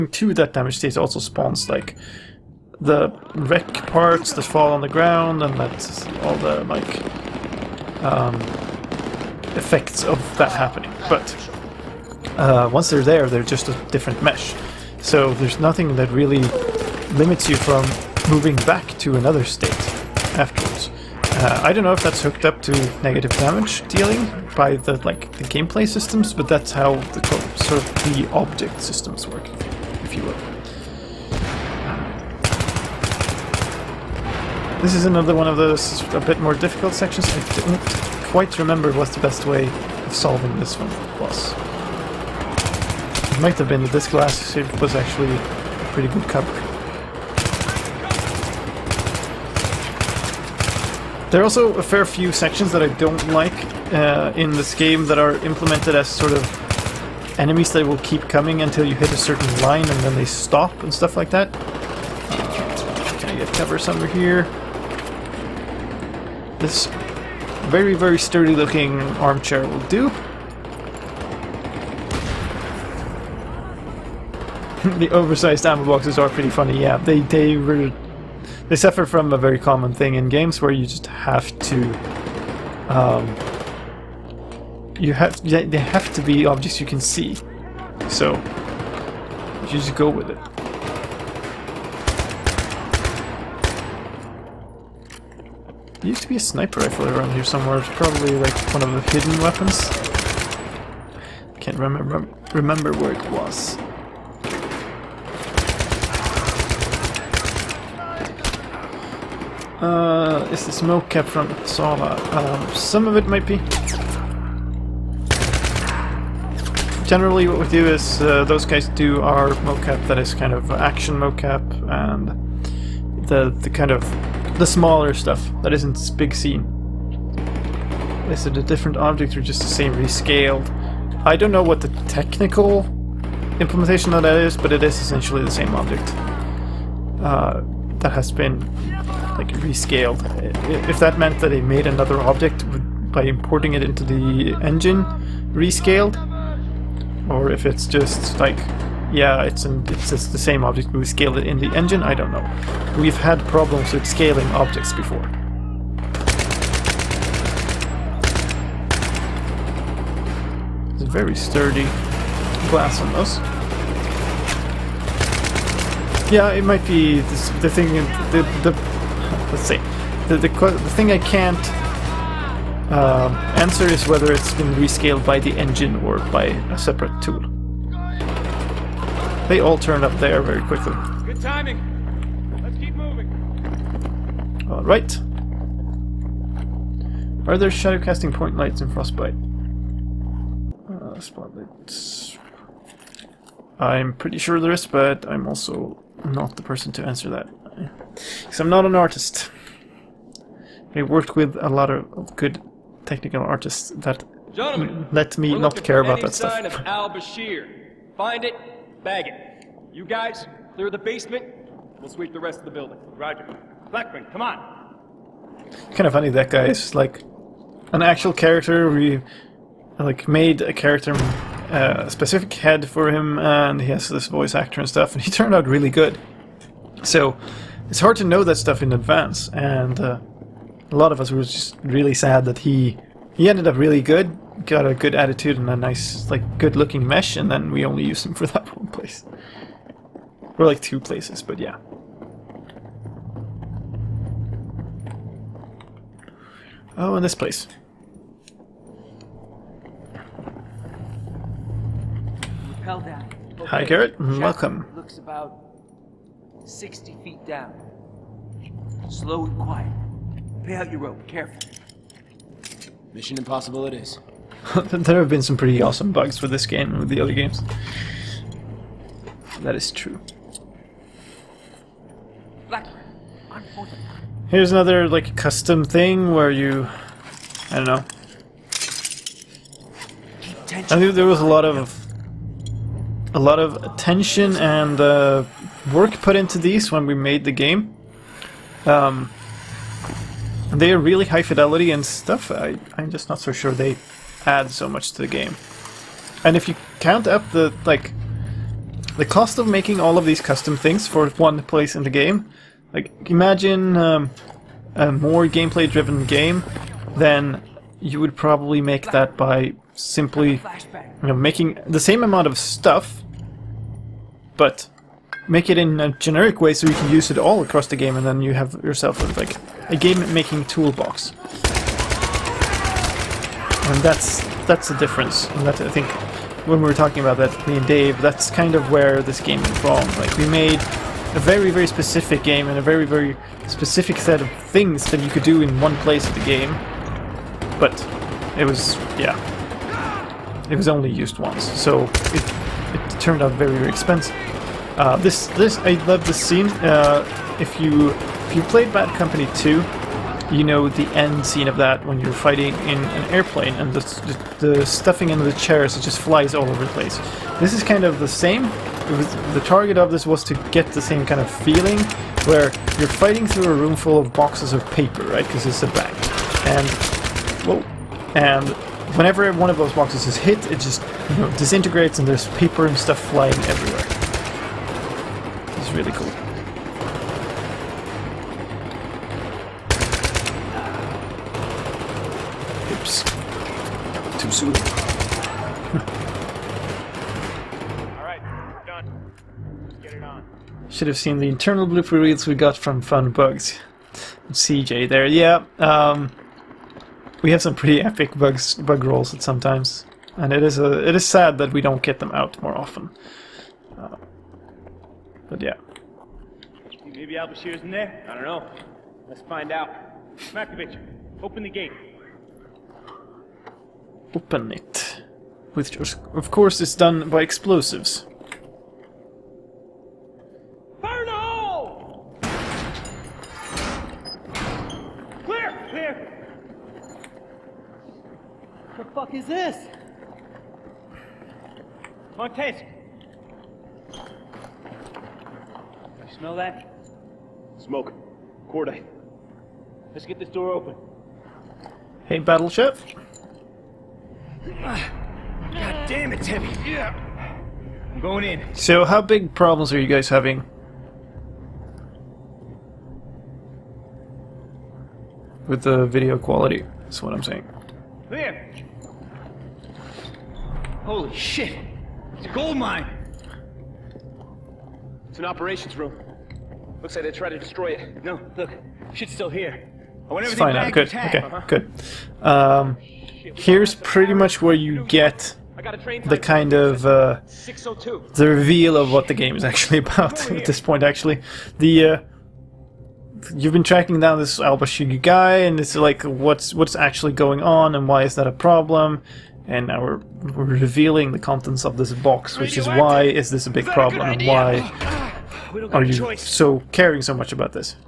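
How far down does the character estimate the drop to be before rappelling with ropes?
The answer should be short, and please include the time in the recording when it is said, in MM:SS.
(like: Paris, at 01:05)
60 feet, at 04:16.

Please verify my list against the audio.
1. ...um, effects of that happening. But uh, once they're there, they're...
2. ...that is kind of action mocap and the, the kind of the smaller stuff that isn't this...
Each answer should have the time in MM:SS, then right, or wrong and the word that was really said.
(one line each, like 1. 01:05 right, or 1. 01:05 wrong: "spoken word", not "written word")
1. 00:08 right
2. 02:00 right.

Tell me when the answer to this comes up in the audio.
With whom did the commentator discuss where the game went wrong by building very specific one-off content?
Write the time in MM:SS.
05:27.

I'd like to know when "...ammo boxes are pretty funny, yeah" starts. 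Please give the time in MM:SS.
01:15.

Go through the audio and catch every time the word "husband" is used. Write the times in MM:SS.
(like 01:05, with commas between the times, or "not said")
not said.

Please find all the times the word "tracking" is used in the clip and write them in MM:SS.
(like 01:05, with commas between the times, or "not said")
08:03.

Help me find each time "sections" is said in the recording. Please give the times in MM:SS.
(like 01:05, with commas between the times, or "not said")
00:36, 00:52.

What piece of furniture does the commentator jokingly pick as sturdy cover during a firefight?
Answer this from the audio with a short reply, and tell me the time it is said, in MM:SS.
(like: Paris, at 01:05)
armchair, at 01:09.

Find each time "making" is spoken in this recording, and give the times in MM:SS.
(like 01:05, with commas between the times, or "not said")
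04:59, 05:11, 05:19.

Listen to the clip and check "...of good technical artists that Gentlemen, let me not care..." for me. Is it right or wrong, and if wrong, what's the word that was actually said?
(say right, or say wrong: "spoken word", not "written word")
right.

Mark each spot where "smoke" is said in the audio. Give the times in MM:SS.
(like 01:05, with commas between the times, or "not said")
01:50, 07:17.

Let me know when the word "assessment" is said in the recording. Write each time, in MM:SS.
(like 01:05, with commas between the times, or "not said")
not said.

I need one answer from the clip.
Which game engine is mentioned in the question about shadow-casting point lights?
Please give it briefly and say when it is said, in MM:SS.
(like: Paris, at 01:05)
Frostbite, at 03:08.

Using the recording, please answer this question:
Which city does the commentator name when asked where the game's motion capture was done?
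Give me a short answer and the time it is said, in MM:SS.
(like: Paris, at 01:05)
Uppsala, at 01:51.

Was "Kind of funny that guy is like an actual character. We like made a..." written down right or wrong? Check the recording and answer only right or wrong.
right.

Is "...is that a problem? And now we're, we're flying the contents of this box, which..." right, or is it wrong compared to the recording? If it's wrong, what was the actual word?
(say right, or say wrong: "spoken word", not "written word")
wrong: "revealing", not "flying".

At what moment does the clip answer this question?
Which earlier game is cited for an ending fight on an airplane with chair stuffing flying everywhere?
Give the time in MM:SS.
05:48.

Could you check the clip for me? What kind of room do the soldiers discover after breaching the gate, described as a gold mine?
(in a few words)
operations room.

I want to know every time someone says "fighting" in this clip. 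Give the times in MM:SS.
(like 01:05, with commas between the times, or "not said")
05:52, 06:03.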